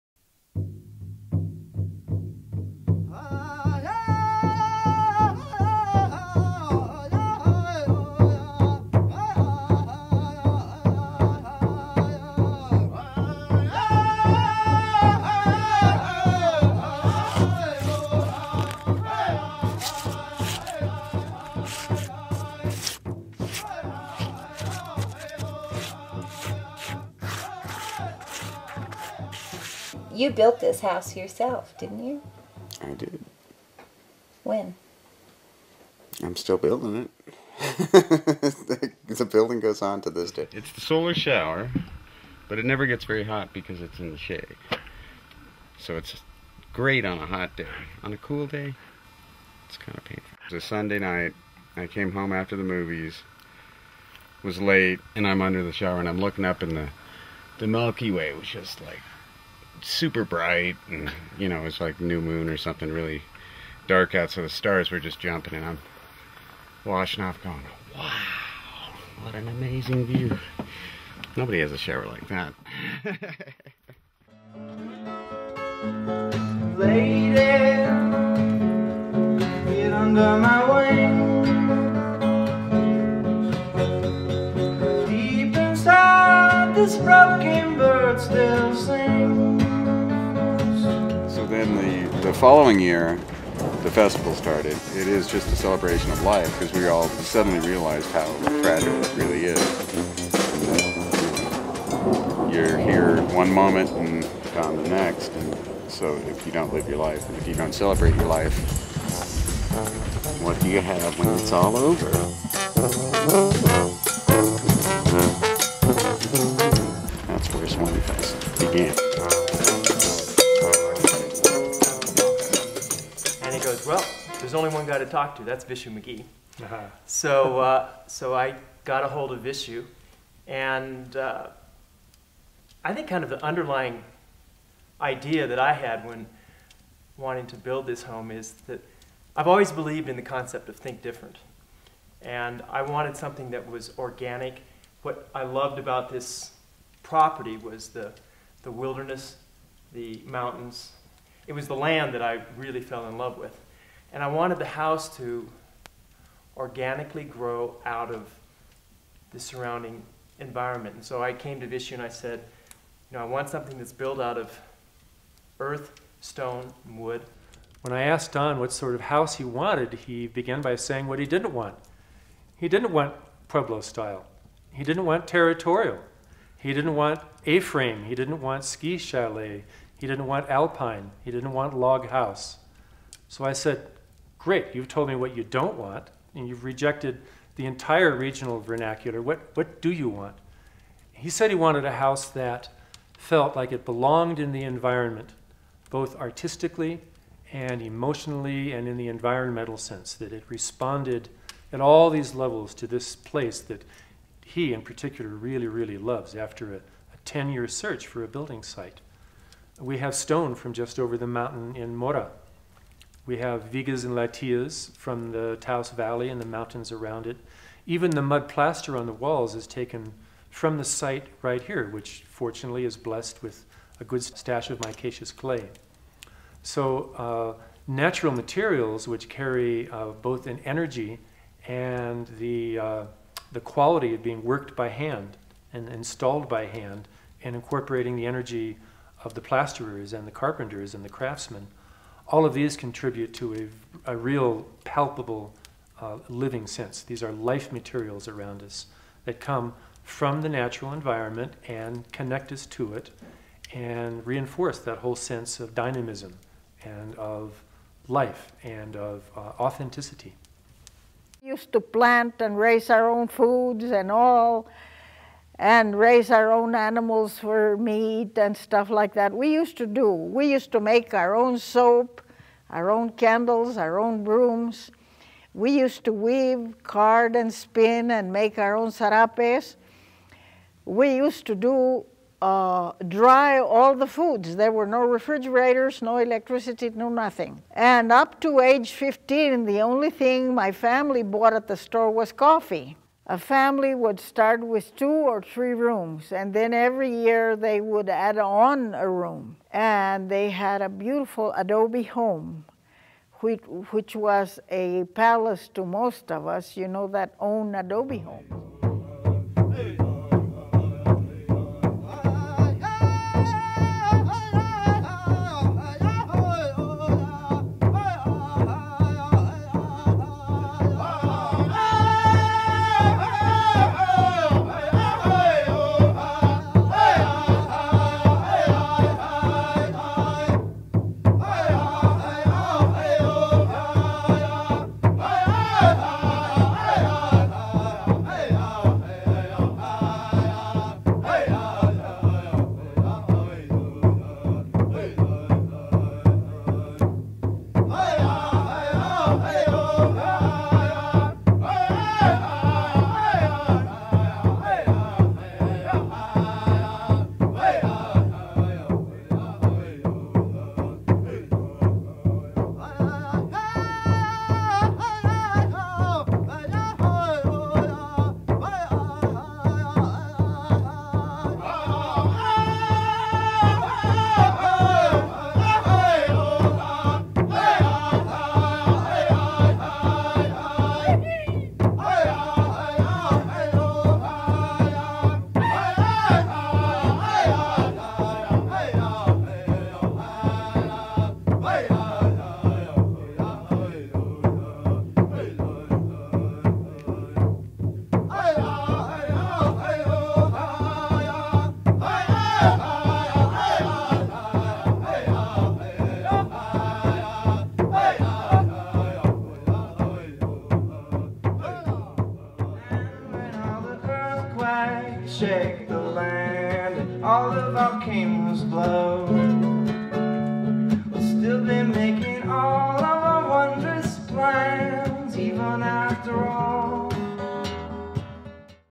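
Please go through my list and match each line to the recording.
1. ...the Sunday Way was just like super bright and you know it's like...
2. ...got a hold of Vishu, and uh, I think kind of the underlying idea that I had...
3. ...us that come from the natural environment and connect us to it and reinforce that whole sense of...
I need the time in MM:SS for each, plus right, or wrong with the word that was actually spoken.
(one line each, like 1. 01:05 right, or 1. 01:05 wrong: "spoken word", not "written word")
1. 00:57 wrong: "Milky", not "Sunday"
2. 02:08 right
3. 04:08 right.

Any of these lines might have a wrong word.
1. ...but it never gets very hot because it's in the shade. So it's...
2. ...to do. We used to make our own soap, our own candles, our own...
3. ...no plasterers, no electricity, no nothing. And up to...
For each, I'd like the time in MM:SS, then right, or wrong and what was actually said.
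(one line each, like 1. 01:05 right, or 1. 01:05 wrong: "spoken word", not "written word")
1. 00:42 right
2. 04:29 right
3. 04:44 wrong: "refrigerators", not "plasterers".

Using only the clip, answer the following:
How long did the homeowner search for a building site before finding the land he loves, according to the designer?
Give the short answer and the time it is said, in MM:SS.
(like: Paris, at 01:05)
10 years, at 03:27.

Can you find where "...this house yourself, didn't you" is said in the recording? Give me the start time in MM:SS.
00:30.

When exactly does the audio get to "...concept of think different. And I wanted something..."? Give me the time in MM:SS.
02:20.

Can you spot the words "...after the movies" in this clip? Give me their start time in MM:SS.
00:52.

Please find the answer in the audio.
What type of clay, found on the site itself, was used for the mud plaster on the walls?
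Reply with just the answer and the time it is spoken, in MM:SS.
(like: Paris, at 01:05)
micaceous clay, at 03:44.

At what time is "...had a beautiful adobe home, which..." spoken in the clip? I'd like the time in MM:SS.
05:00.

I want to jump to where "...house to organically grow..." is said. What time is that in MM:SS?
02:34.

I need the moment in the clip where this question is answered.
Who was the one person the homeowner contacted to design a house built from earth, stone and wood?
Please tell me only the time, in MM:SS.
02:05.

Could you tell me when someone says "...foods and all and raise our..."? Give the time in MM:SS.
04:23.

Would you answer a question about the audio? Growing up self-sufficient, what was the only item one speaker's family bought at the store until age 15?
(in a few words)
coffee.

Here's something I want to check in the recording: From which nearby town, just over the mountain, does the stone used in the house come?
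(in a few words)
Mora.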